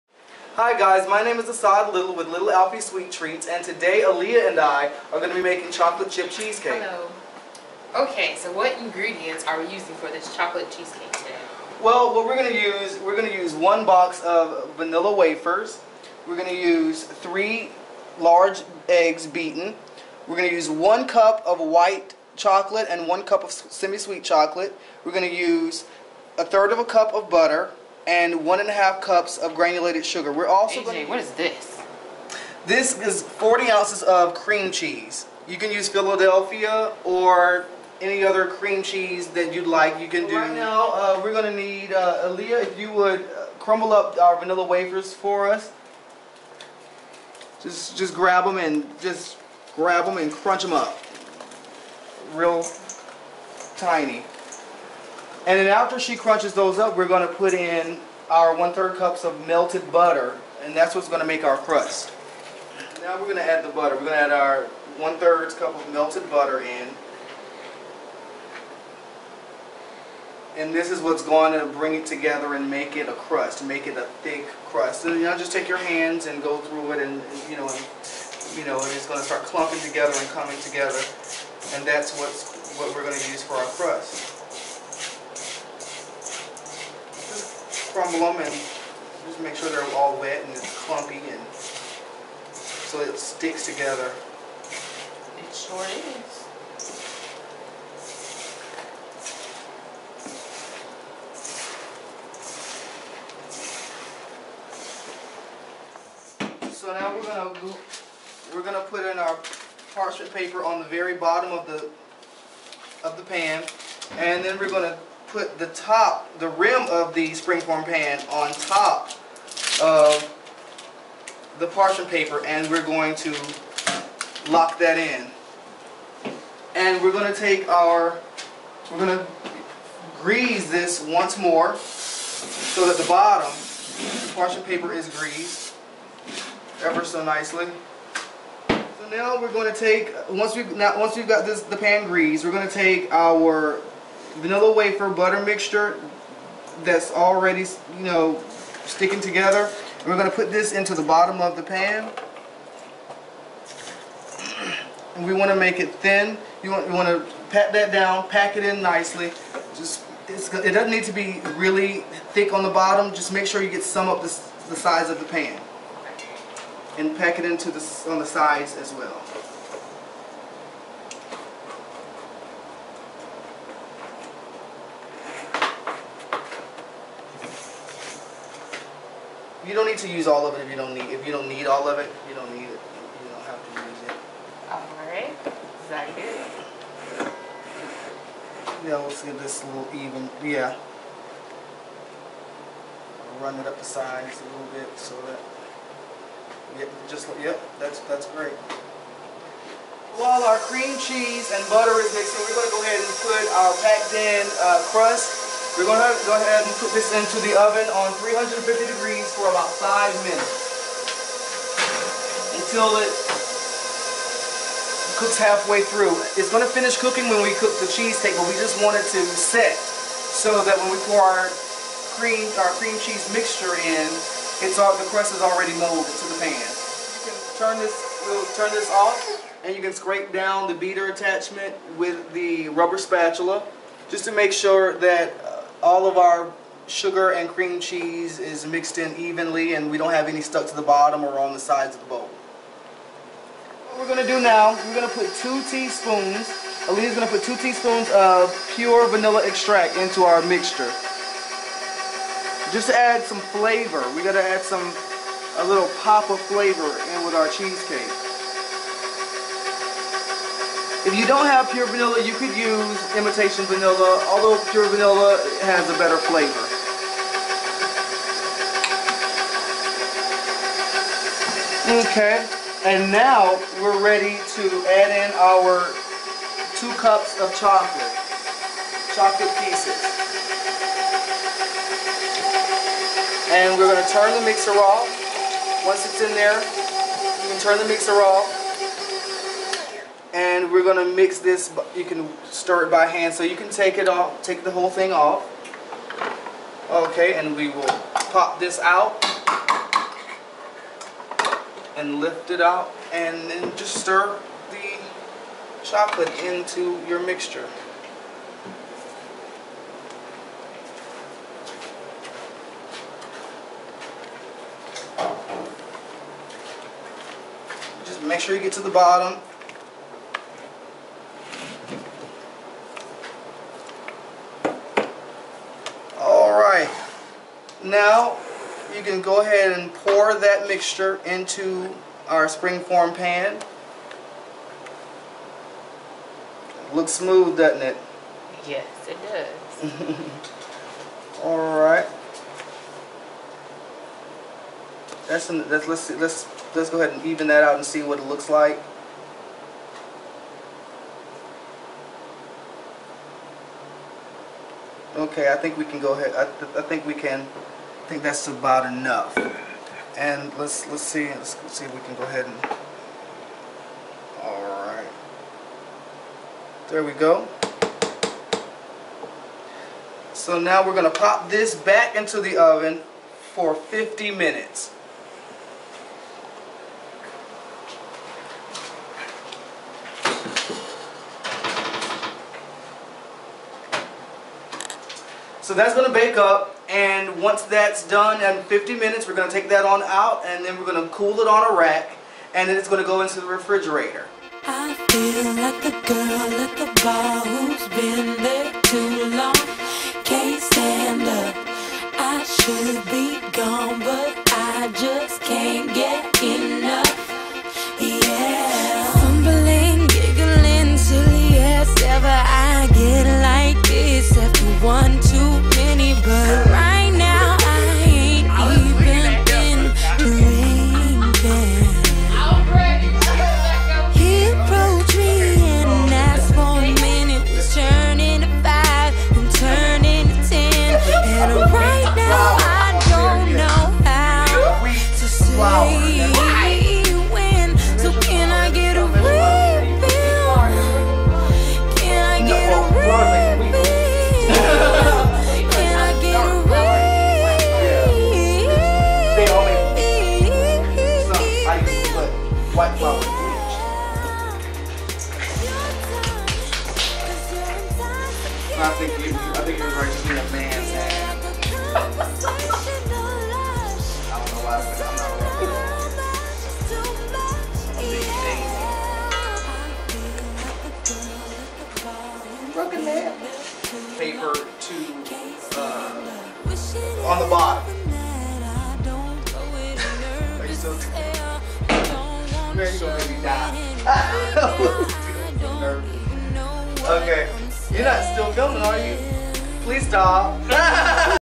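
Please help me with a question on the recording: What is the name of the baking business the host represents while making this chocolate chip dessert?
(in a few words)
Little Alfies Sweet Treats.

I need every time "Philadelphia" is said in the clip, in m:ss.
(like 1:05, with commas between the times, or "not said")
0:35.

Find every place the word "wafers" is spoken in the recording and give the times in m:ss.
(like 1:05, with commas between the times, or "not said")
0:15, 0:44, 2:24.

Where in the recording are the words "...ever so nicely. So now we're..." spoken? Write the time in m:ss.
2:16.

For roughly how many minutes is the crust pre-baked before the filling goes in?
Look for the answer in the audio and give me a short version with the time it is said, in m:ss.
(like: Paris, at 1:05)
5 minutes, at 3:29.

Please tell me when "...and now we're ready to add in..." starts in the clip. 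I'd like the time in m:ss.
4:32.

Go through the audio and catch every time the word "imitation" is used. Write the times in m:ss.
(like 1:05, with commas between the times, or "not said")
4:23.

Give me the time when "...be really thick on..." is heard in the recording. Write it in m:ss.
2:41.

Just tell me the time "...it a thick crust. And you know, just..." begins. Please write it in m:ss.
1:13.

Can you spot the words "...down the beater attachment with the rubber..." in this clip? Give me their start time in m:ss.
3:50.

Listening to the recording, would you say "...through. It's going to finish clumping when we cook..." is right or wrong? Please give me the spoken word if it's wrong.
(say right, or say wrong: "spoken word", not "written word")
wrong: "cooking", not "clumping".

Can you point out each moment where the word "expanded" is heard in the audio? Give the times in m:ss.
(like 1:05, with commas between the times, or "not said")
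not said.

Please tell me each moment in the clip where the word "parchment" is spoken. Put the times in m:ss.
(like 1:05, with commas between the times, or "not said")
1:49, 2:01, 2:14.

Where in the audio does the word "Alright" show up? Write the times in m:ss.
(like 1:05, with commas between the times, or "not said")
5:41.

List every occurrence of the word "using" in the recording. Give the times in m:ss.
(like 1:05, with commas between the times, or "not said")
0:09.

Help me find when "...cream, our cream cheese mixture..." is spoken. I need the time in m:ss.
3:42.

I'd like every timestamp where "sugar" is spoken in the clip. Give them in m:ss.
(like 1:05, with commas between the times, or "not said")
0:30, 3:56.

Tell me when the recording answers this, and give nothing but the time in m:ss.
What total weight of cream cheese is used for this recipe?
0:33.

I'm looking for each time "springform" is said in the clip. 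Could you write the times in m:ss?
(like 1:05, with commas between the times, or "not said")
1:57, 5:32.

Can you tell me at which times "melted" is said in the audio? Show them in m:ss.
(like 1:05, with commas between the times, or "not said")
0:59, 1:05.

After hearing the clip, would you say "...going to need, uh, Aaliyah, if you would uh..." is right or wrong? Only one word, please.
right.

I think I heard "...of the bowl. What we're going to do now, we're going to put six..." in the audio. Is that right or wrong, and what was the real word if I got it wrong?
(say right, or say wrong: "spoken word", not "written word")
wrong: "two", not "six".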